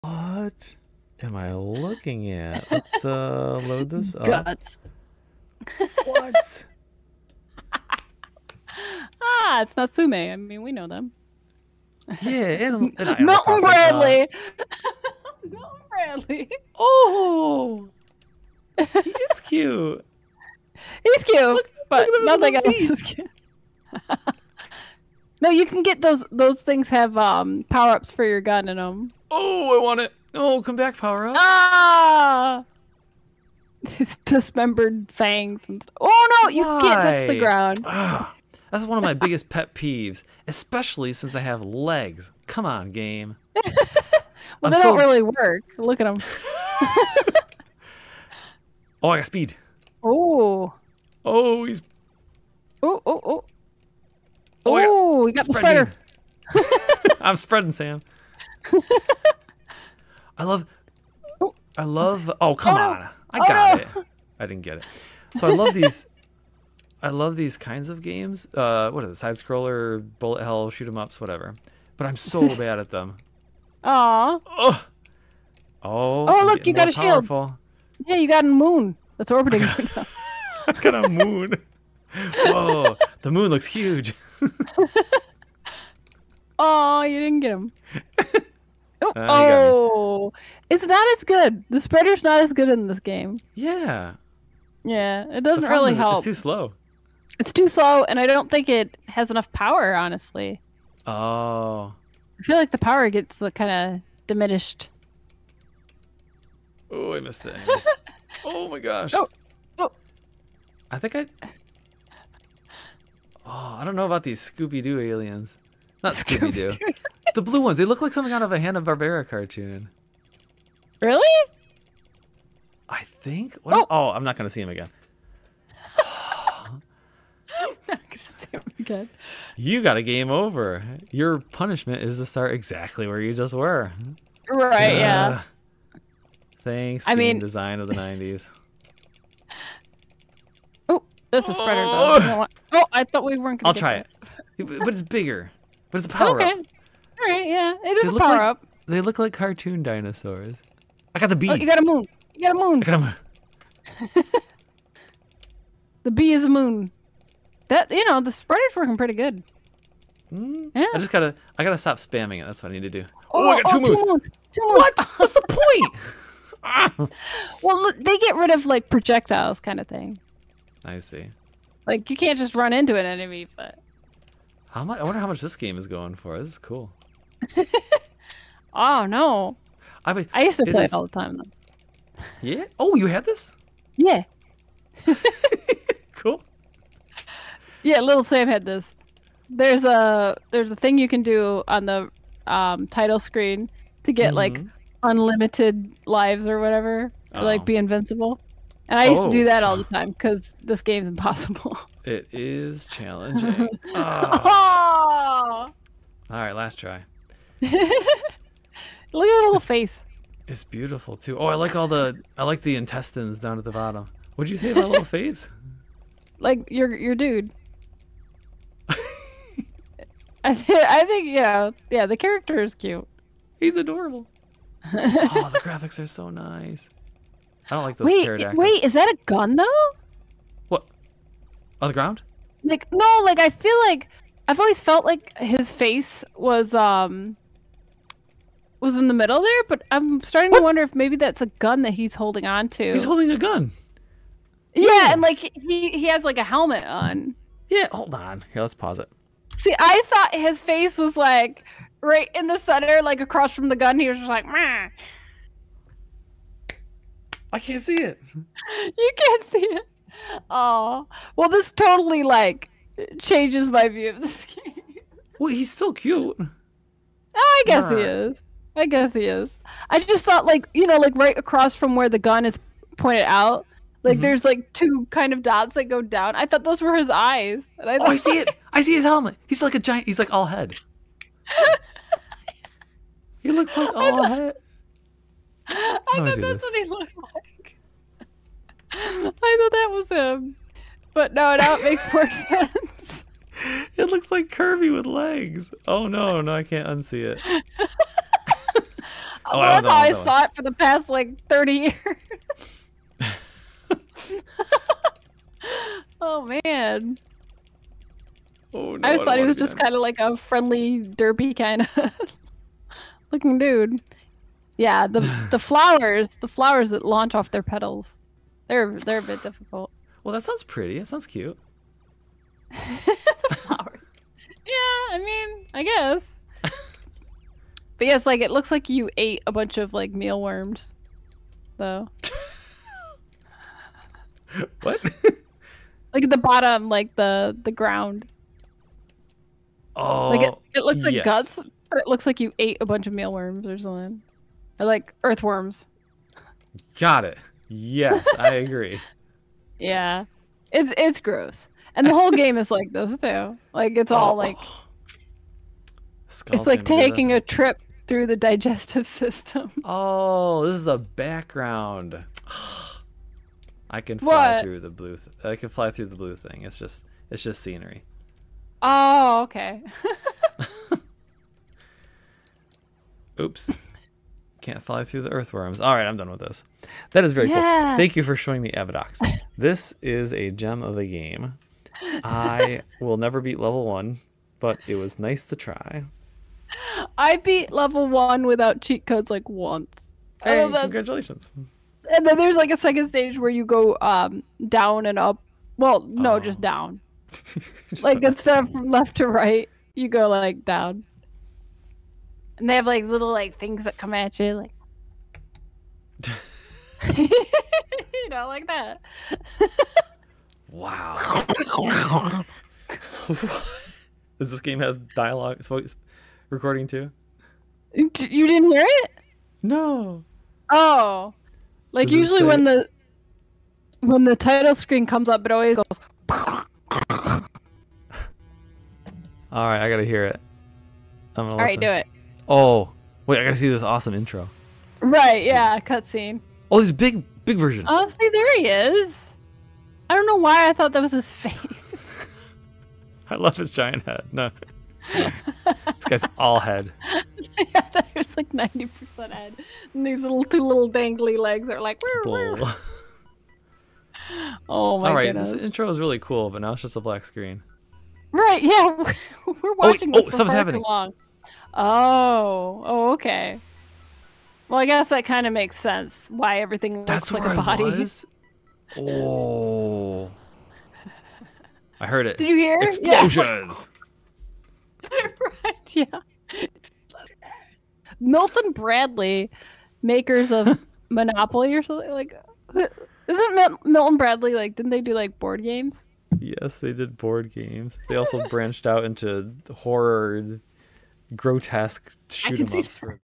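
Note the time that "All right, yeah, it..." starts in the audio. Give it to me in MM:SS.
02:27.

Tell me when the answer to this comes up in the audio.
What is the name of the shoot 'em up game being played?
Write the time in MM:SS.
06:18.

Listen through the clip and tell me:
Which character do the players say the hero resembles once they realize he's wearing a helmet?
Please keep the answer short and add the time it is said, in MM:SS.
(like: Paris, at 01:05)
Kirby, at 04:54.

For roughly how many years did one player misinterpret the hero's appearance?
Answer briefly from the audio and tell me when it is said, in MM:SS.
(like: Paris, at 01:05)
30, at 05:01.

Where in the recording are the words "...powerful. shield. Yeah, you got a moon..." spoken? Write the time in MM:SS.
01:16.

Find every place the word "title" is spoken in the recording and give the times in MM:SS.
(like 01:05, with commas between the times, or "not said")
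03:12, 07:04.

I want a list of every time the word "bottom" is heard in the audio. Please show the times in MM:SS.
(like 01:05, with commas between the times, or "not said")
03:33, 05:36.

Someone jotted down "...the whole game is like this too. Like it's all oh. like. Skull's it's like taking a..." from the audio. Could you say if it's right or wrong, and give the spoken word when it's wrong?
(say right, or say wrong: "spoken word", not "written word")
right.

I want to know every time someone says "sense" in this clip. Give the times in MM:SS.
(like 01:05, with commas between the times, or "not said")
04:52, 07:45.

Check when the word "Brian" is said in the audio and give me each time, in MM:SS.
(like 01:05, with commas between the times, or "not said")
not said.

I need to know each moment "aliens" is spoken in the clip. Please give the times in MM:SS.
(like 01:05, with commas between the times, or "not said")
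01:54.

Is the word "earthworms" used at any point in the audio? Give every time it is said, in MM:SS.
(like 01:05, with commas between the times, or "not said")
05:45, 06:15.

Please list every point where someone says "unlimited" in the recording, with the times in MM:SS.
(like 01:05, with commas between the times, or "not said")
03:15.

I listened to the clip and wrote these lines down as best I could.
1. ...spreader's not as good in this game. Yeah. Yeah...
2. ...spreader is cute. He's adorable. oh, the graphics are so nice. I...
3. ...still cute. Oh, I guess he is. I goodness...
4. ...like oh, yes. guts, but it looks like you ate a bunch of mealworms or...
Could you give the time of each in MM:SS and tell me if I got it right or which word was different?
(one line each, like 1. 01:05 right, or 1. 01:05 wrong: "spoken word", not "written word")
1. 01:31 right
2. 03:42 wrong: "character", not "spreader"
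3. 04:25 wrong: "guess", not "goodness"
4. 05:41 right.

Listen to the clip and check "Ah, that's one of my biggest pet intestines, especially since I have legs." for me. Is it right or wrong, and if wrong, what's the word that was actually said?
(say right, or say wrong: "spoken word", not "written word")
wrong: "peeves", not "intestines".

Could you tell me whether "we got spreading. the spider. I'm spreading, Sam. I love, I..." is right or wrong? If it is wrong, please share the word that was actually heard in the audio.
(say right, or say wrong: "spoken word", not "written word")
right.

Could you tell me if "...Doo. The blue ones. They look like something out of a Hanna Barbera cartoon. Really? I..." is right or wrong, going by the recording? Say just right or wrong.
right.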